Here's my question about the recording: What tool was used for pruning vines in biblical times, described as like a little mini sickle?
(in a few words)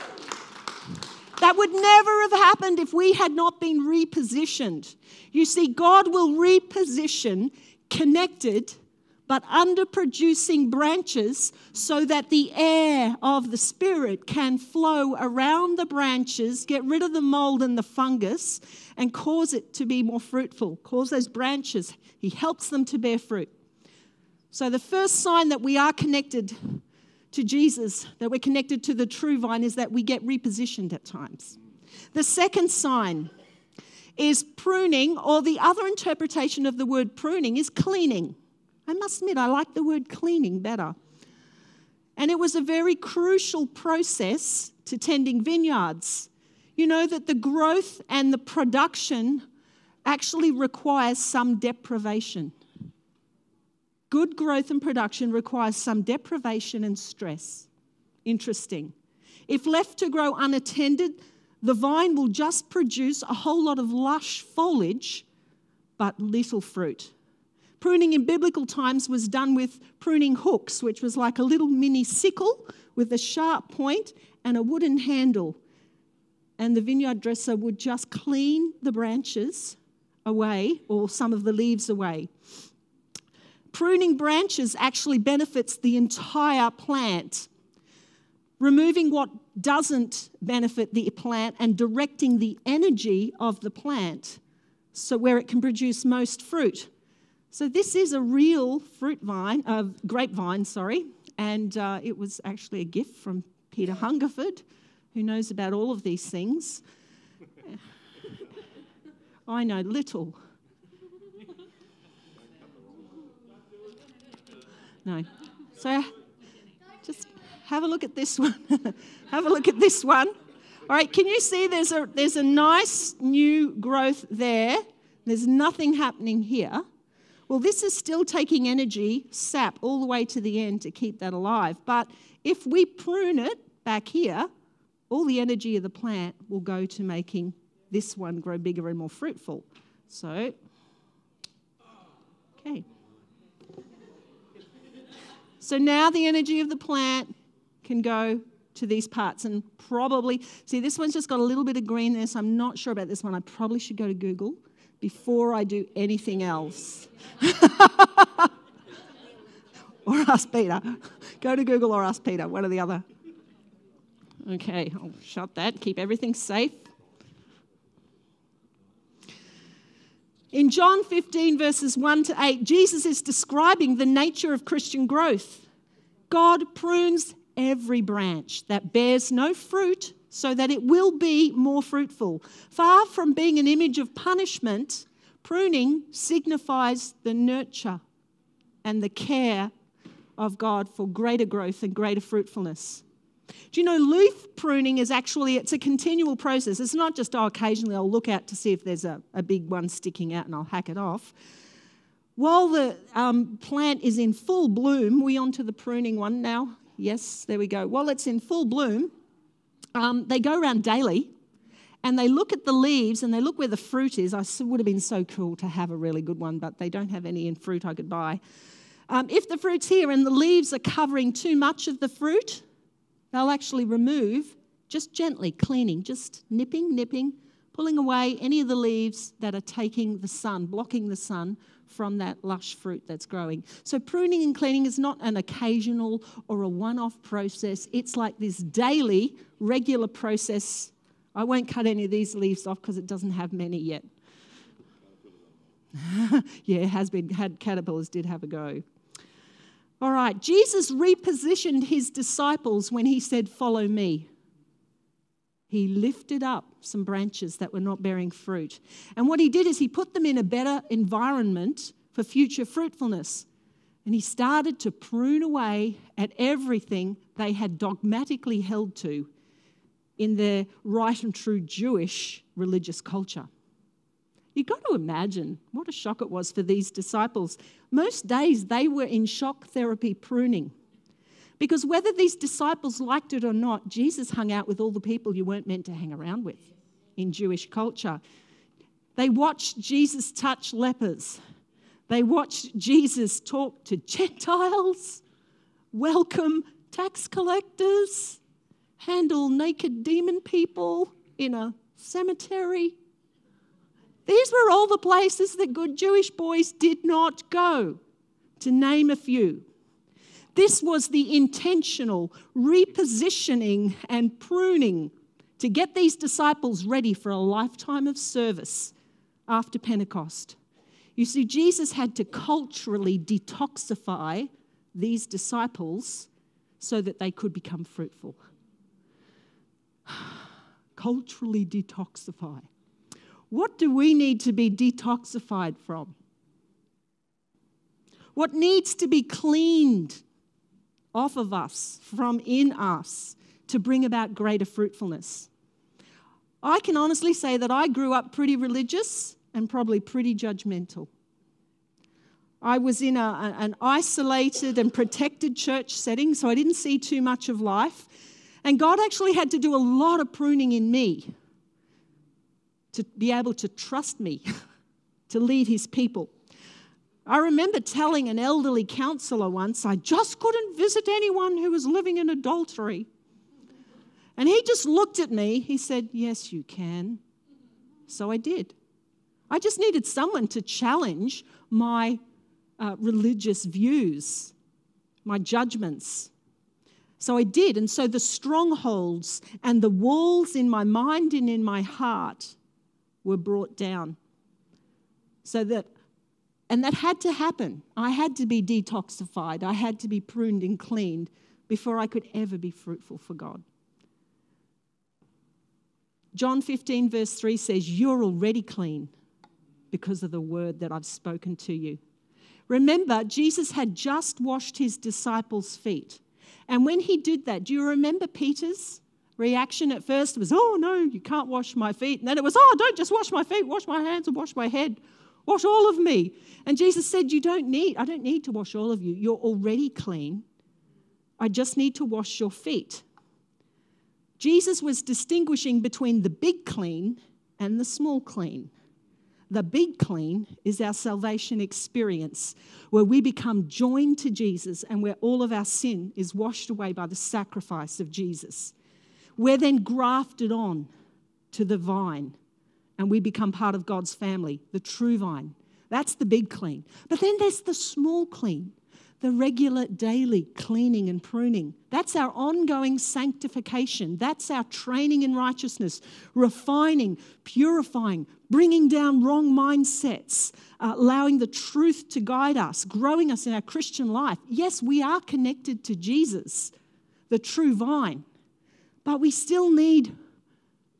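Pruning hooks.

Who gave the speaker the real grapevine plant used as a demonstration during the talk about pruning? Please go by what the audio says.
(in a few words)
Peter Hungerford.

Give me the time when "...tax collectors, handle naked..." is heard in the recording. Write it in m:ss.
4:56.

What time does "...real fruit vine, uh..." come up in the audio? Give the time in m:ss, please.
1:38.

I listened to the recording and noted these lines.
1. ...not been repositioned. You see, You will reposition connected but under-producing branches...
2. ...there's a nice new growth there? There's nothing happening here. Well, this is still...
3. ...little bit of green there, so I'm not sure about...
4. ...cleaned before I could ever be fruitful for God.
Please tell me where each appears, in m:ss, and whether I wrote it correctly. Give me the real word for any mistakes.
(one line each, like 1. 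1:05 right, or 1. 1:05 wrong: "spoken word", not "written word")
1. 0:03 wrong: "God", not "You"
2. 2:02 right
3. 2:31 right
4. 6:40 right.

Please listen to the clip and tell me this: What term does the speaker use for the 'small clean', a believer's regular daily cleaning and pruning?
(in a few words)
Ongoing sanctification.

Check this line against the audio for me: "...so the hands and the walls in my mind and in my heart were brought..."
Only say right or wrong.
wrong.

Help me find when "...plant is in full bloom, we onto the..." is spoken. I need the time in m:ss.
3:23.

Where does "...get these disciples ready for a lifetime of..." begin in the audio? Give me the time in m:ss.
5:15.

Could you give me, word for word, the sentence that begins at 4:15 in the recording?
He lifted up some branches that were not bearing fruit.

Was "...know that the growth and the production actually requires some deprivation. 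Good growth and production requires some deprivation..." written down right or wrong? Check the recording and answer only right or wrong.
right.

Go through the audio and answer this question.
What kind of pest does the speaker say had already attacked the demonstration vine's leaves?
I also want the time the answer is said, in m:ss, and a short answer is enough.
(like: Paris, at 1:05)
Caterpillars, at 4:07.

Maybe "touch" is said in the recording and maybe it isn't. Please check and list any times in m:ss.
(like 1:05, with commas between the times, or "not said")
4:50.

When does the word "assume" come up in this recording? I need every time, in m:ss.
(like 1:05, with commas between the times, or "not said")
not said.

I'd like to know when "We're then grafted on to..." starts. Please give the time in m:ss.
7:29.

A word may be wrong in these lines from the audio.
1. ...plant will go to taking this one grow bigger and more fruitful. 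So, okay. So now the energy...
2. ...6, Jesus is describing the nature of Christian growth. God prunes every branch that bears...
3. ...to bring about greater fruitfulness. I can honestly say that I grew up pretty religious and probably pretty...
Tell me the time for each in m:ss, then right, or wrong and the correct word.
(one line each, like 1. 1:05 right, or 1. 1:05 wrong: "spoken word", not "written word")
1. 2:15 wrong: "making", not "taking"
2. 2:52 wrong: "8", not "6"
3. 5:43 right.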